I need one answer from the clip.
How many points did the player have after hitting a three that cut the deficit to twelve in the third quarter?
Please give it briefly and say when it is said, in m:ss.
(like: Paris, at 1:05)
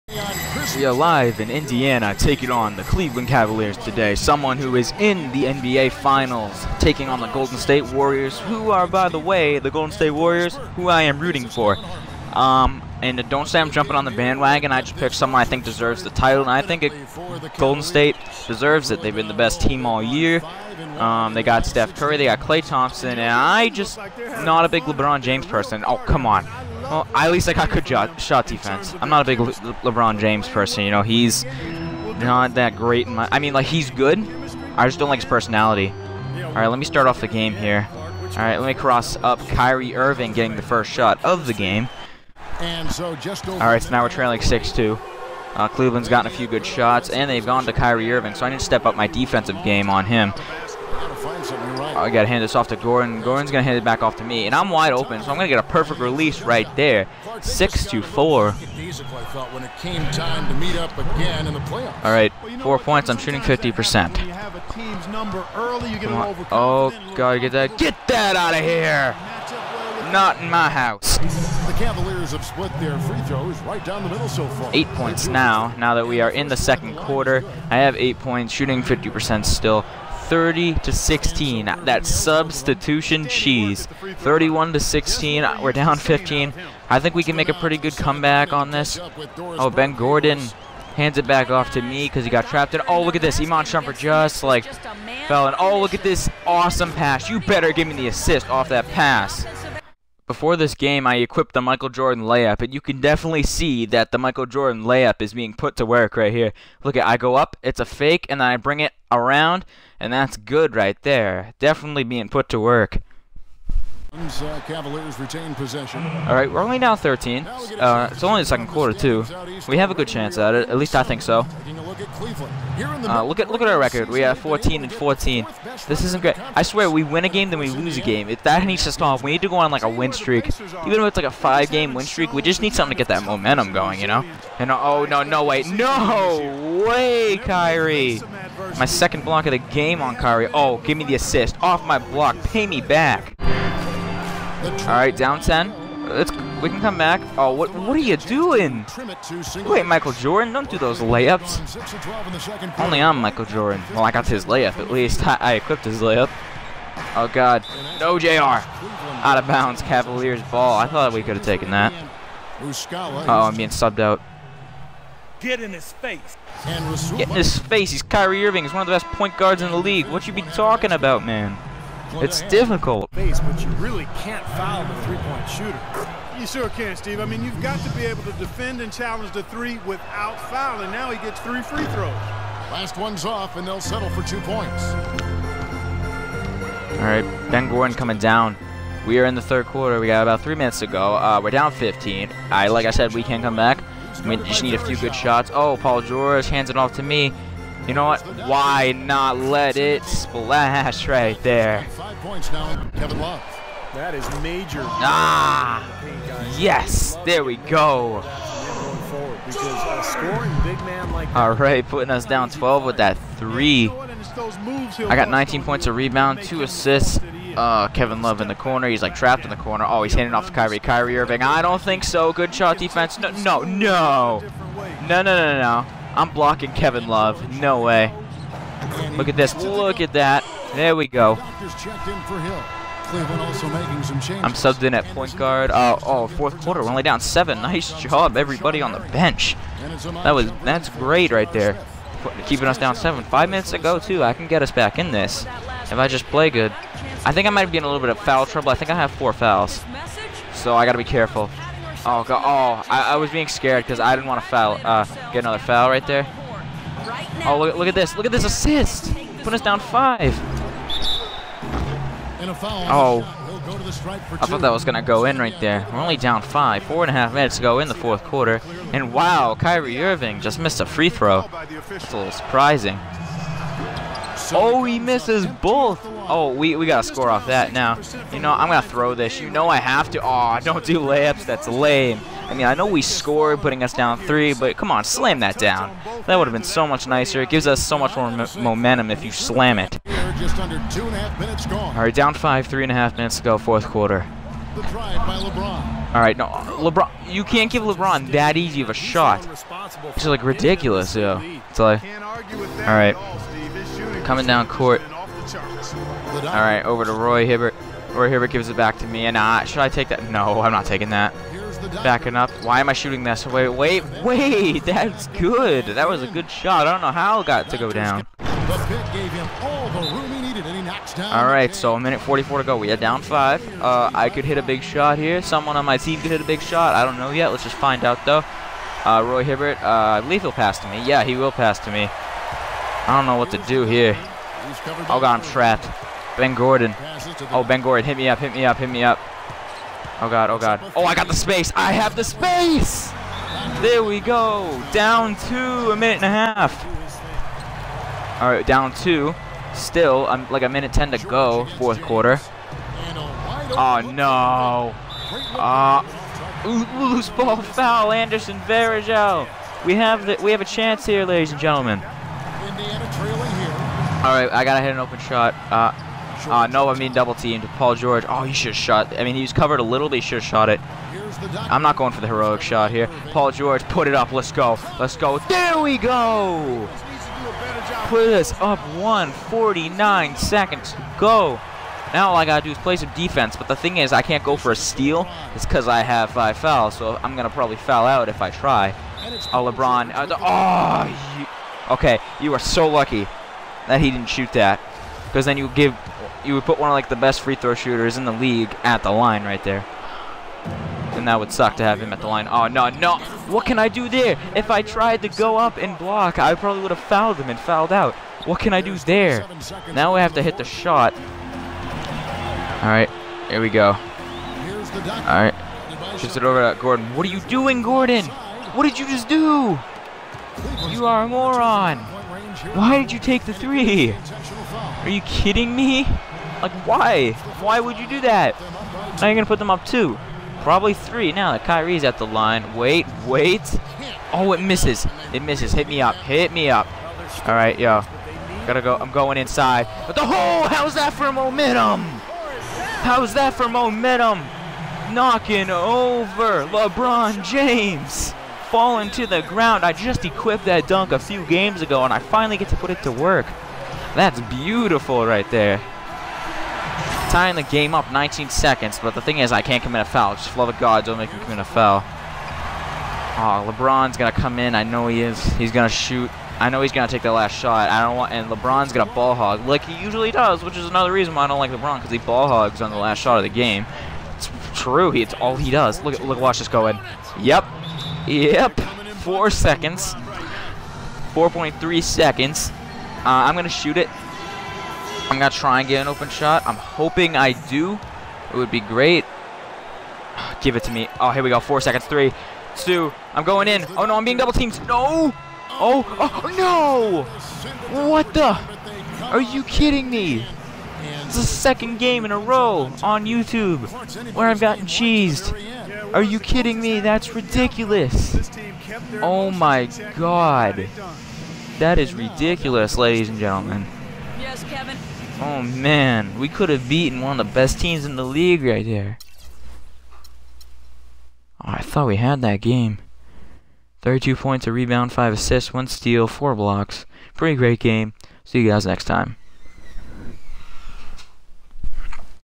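19, at 3:35.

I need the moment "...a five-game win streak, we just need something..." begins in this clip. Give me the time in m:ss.
2:11.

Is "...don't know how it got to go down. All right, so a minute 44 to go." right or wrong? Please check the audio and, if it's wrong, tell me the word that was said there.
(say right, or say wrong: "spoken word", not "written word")
right.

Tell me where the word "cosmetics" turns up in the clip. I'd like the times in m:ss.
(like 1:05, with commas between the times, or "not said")
not said.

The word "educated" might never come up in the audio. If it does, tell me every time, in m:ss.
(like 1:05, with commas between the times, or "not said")
not said.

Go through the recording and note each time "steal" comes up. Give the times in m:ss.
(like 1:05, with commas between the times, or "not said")
6:24, 8:45.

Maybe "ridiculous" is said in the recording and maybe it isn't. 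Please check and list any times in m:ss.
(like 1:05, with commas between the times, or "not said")
5:00, 8:27, 8:32.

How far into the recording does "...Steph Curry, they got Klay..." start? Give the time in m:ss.
0:21.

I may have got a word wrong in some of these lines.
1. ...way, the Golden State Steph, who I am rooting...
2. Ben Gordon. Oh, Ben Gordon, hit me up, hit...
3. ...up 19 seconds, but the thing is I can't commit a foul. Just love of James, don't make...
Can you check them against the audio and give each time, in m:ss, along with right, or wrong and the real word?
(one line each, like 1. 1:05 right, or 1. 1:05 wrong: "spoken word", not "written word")
1. 0:09 wrong: "Warriors", not "Steph"
2. 5:36 right
3. 7:37 wrong: "God", not "James".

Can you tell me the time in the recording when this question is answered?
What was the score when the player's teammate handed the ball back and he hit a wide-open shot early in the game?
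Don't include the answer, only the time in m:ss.
0:57.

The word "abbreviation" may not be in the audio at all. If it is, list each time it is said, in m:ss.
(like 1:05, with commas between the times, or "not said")
not said.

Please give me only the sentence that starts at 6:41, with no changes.
And that would suck to have him at the line.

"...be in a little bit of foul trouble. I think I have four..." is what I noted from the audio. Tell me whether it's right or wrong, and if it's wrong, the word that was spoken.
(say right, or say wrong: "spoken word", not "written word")
right.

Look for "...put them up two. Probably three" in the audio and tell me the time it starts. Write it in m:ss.
7:09.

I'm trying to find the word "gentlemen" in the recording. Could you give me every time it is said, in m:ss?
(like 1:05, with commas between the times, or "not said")
6:01, 8:33.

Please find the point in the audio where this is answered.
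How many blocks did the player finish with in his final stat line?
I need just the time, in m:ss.
8:46.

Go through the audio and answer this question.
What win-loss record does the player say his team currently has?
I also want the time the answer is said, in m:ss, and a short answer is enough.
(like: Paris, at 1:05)
14 and 14, at 2:04.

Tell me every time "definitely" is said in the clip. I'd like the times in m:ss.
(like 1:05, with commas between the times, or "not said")
1:43, 1:51.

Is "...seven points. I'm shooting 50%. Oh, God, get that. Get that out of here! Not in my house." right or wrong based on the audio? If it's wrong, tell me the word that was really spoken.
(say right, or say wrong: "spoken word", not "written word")
wrong: "four", not "seven".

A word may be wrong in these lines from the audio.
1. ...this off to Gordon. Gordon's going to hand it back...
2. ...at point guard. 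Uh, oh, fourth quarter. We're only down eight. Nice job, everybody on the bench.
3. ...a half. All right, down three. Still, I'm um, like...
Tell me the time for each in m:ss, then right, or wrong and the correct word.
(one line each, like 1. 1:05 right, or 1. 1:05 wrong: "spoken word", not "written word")
1. 0:52 right
2. 3:54 wrong: "seven", not "eight"
3. 5:46 wrong: "two", not "three".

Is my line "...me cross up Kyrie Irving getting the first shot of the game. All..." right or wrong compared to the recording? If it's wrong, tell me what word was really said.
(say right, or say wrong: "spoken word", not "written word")
right.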